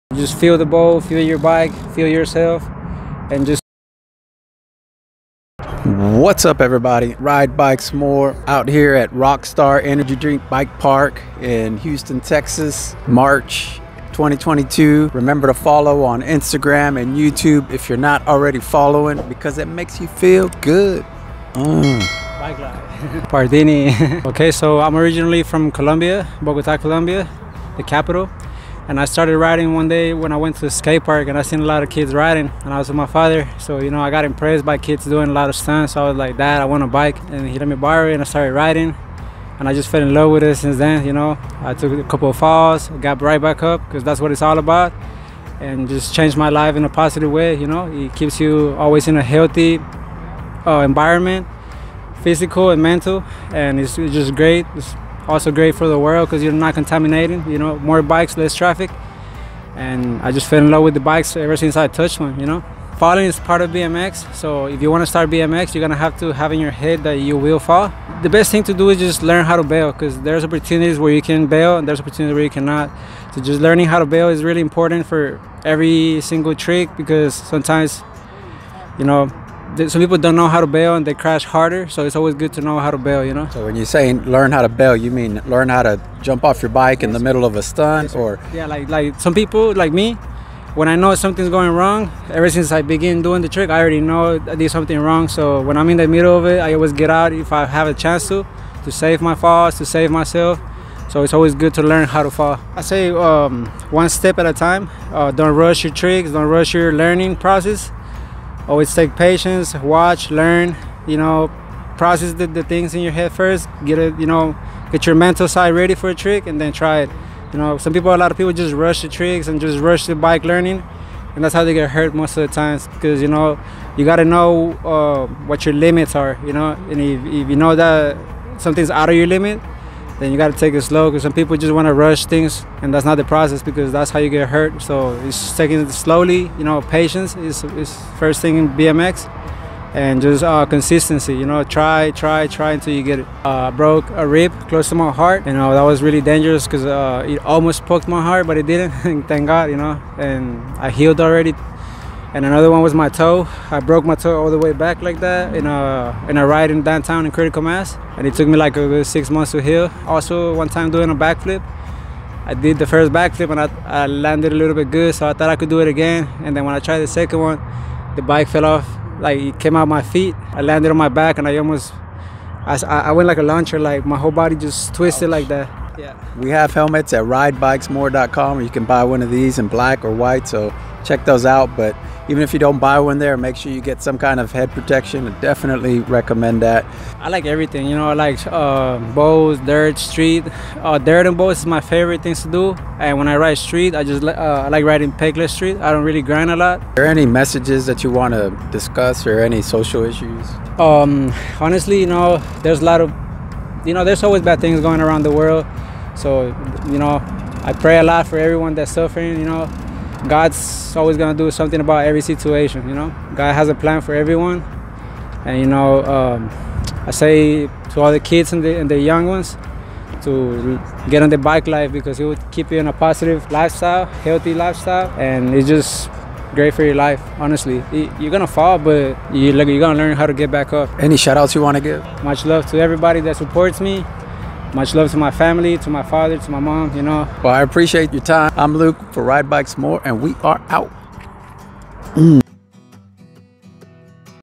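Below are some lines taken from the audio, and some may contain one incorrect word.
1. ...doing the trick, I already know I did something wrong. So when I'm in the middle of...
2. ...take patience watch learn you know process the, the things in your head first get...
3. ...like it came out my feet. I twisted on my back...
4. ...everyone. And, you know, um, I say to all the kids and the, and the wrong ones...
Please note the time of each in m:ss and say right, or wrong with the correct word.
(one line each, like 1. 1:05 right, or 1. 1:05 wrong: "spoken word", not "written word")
1. 1:33 right
2. 1:48 right
3. 2:49 wrong: "landed", not "twisted"
4. 3:34 wrong: "young", not "wrong".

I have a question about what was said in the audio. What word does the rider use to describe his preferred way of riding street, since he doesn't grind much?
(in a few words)
Pegless.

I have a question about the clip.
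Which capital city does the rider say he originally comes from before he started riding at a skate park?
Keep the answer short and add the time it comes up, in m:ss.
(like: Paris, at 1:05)
Bogota, at 0:26.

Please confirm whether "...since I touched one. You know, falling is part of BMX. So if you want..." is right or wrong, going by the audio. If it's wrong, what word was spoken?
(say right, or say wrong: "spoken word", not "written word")
right.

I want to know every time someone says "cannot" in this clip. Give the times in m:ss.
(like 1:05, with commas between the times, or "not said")
1:12.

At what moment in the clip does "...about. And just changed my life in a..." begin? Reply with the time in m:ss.
0:44.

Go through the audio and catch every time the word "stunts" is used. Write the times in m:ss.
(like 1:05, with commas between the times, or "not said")
0:35, 1:27.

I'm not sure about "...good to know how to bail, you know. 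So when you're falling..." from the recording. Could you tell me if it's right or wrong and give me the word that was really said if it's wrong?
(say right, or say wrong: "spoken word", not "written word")
wrong: "saying", not "falling".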